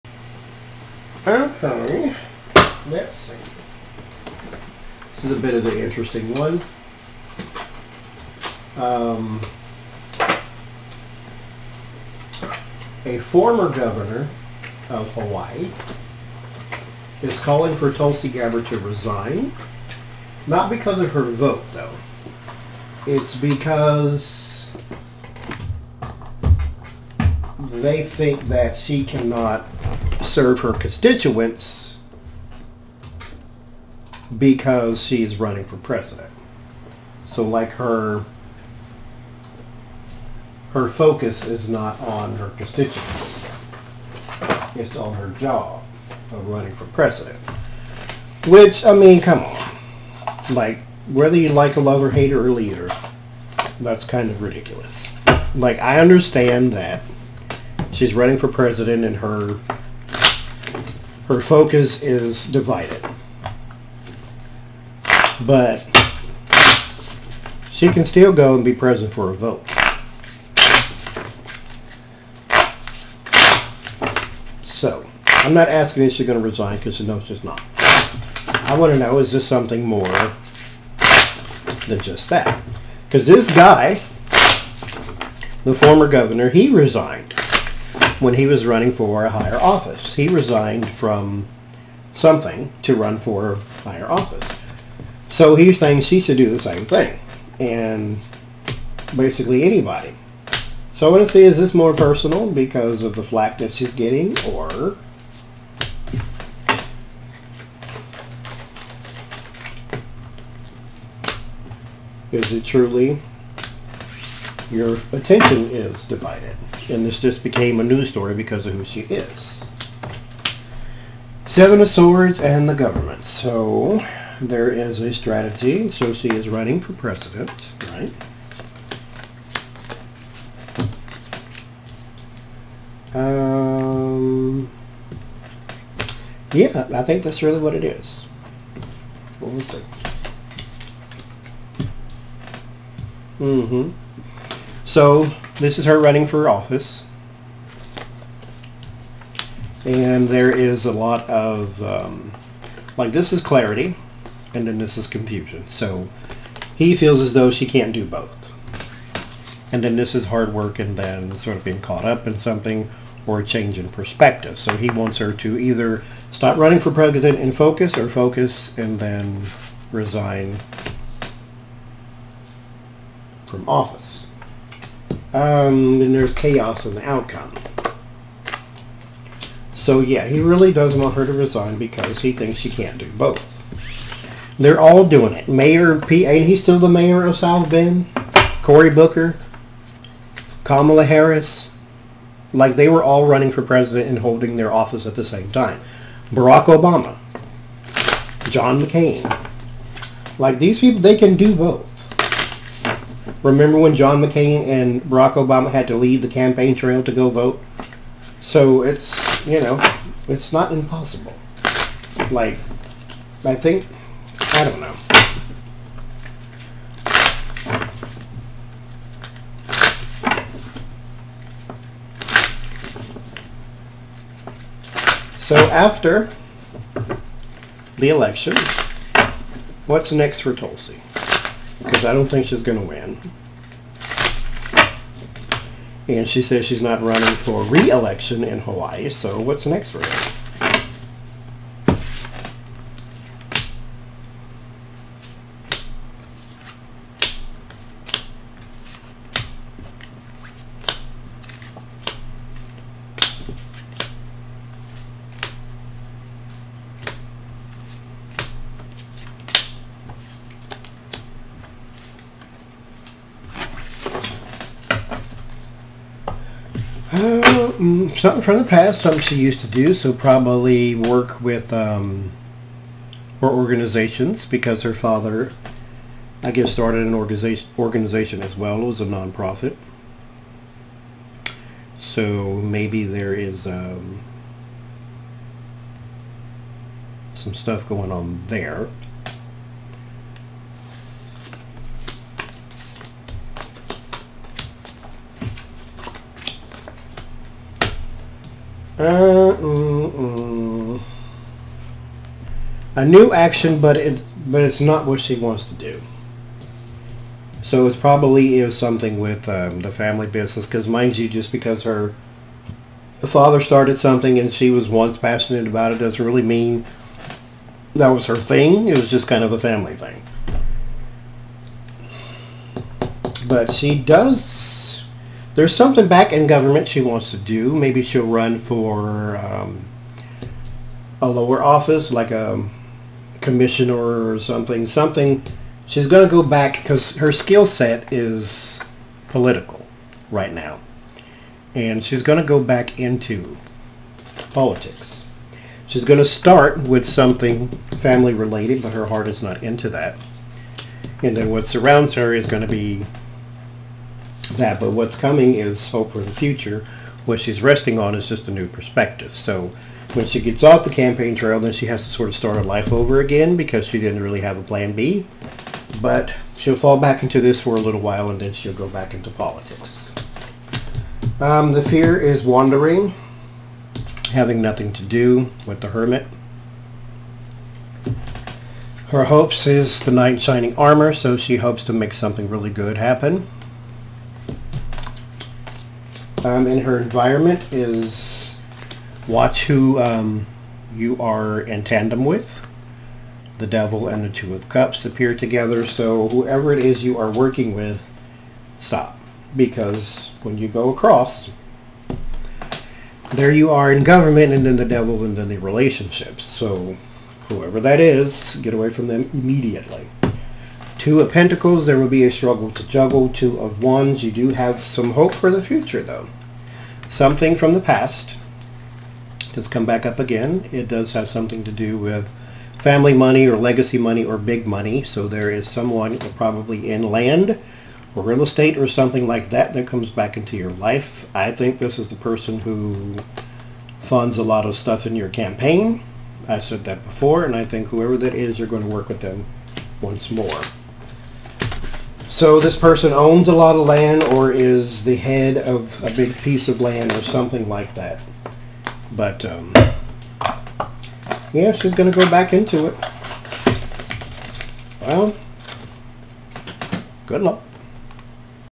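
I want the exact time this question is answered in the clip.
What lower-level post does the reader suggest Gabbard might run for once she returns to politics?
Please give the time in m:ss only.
5:33.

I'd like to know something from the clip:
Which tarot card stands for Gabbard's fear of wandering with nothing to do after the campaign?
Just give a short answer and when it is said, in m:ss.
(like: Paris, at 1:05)
The Hermit, at 6:15.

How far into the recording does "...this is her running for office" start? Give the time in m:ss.
2:25.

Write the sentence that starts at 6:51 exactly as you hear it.
Two of Pentacles, there will be a struggle to juggle.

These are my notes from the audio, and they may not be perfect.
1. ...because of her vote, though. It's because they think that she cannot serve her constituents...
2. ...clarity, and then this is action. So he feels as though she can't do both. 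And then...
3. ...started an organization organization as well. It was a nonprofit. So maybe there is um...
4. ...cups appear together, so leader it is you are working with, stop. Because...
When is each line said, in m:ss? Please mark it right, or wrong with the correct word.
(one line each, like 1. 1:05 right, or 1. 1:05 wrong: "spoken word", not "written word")
1. 0:20 right
2. 2:33 wrong: "confusion", not "action"
3. 4:36 right
4. 6:34 wrong: "whoever", not "leader".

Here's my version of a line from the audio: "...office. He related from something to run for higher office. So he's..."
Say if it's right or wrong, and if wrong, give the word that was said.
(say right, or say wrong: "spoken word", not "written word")
wrong: "resigned", not "related".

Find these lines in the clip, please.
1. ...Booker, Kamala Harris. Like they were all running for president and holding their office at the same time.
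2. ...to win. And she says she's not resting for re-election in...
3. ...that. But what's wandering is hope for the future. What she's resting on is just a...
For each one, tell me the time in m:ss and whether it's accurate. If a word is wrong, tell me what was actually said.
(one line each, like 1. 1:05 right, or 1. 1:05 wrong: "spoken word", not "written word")
1. 3:08 right
2. 3:52 wrong: "running", not "resting"
3. 5:54 wrong: "coming", not "wandering".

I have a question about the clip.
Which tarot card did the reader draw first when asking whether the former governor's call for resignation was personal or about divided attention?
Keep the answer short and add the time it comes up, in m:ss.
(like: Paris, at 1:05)
Seven of Swords, at 2:01.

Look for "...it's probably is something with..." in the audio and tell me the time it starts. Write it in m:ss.
5:07.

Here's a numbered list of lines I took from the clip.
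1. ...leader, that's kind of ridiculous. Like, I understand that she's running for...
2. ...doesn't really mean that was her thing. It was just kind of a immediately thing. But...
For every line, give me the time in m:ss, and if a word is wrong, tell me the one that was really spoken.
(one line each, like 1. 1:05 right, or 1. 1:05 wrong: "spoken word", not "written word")
1. 0:52 right
2. 5:15 wrong: "family", not "immediately".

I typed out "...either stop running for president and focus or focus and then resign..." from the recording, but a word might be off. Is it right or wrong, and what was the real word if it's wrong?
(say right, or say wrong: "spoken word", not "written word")
right.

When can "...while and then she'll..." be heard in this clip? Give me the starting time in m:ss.
6:08.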